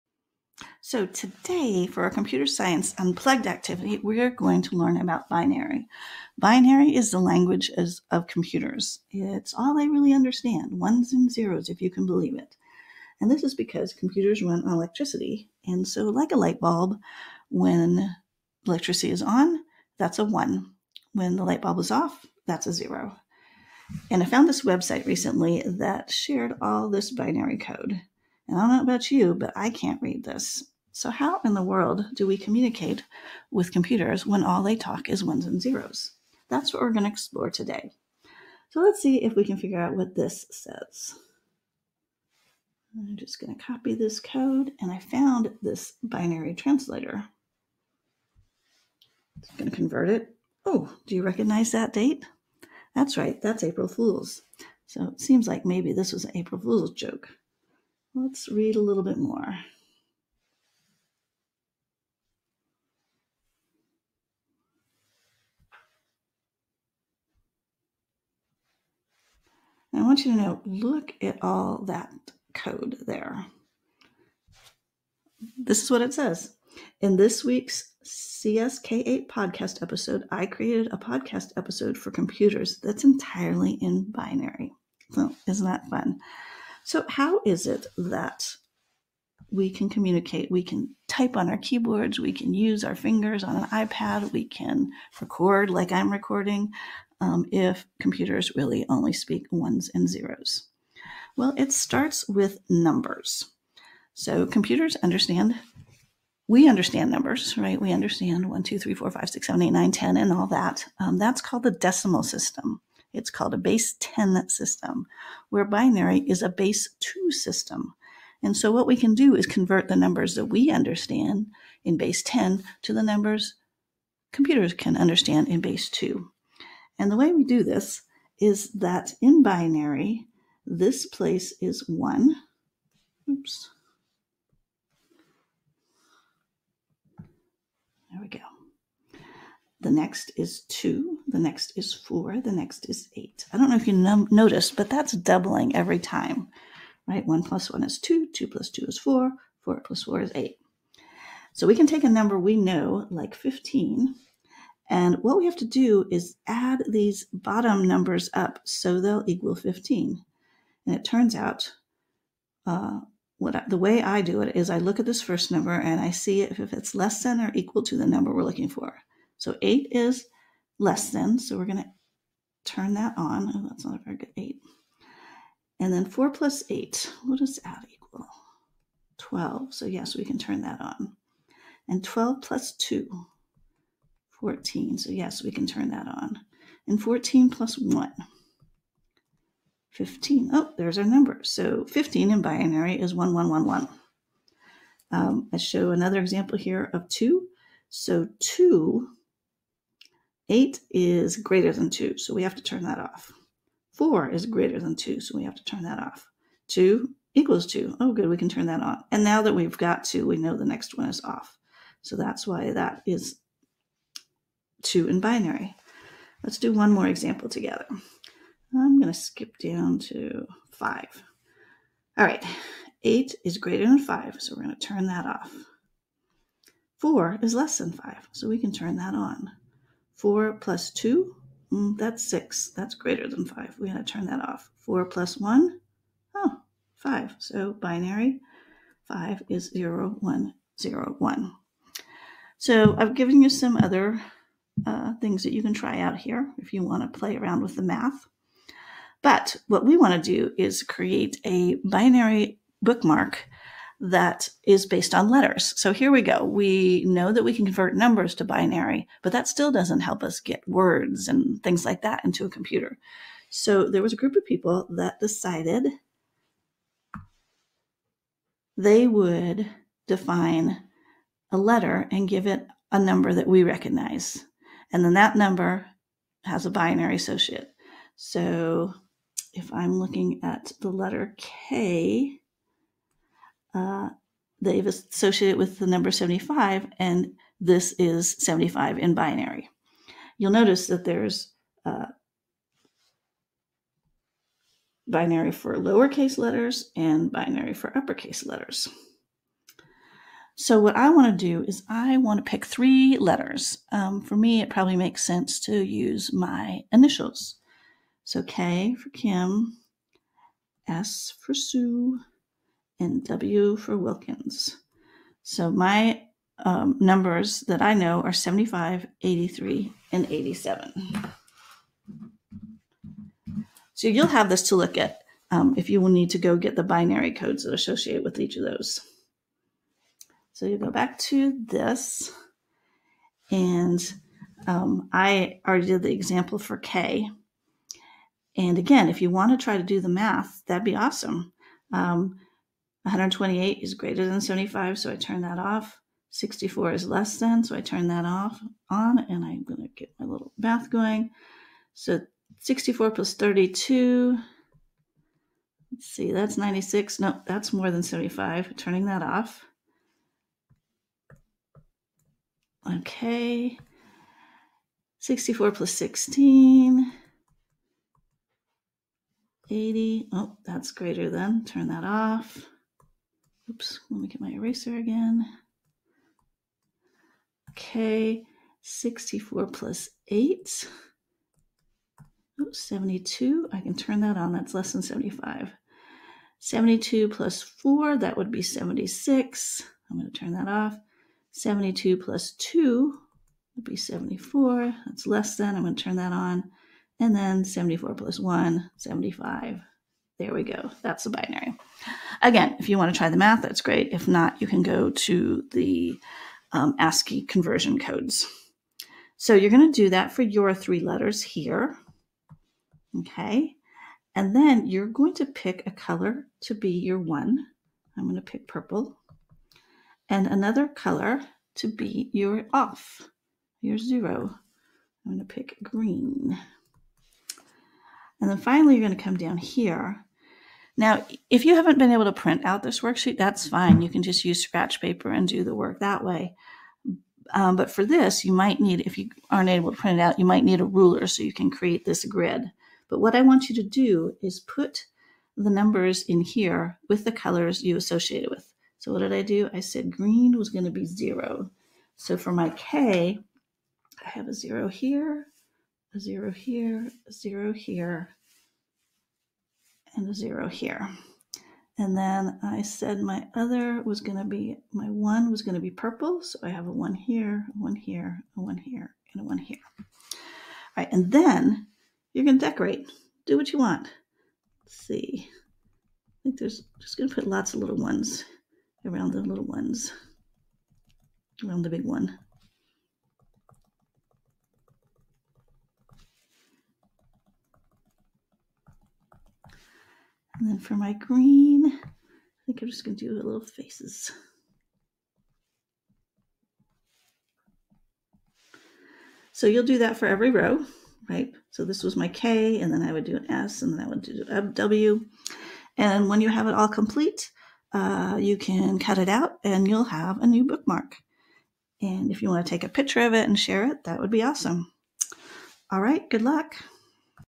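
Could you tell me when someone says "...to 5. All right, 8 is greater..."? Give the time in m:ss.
3:39.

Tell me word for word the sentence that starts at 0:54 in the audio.
So, it seems like maybe this was an April Fool's joke.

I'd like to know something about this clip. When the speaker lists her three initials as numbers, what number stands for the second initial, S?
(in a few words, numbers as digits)
83.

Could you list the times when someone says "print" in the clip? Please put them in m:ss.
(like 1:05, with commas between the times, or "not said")
7:12, 7:19.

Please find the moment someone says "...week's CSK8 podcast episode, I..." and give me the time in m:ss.
1:17.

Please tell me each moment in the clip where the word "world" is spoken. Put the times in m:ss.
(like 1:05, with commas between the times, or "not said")
0:31.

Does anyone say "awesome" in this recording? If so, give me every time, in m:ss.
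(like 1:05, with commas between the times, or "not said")
5:40, 8:34.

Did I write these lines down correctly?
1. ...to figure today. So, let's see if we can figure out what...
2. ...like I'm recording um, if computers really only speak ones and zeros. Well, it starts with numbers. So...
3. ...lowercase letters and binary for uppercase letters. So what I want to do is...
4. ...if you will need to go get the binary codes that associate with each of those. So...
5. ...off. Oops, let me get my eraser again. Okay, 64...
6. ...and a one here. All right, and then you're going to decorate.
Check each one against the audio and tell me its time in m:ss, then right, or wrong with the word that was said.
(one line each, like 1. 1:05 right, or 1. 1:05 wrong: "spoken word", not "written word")
1. 0:37 wrong: "explore", not "figure"
2. 1:35 right
3. 4:55 right
4. 5:25 right
5. 6:12 right
6. 7:49 right.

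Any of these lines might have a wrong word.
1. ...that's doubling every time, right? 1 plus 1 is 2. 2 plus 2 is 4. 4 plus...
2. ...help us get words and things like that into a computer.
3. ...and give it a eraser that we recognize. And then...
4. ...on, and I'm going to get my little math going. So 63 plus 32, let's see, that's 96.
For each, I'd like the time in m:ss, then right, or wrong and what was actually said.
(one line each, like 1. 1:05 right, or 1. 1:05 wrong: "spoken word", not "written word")
1. 2:24 right
2. 4:19 right
3. 4:32 wrong: "number", not "eraser"
4. 5:48 wrong: "64", not "63".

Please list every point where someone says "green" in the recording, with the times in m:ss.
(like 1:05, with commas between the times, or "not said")
7:05, 7:30, 8:11.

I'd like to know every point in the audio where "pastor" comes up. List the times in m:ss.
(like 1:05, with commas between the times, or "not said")
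not said.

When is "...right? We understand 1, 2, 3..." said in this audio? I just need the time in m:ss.
1:47.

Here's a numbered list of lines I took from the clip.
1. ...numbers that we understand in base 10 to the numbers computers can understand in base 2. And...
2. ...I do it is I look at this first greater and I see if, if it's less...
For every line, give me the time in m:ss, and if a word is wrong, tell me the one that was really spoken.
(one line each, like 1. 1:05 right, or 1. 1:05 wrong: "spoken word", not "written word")
1. 1:59 right
2. 2:44 wrong: "number", not "greater".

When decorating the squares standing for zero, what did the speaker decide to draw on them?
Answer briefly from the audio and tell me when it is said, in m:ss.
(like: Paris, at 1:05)
little faces, at 8:13.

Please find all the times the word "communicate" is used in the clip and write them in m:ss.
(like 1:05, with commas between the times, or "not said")
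0:32, 1:29.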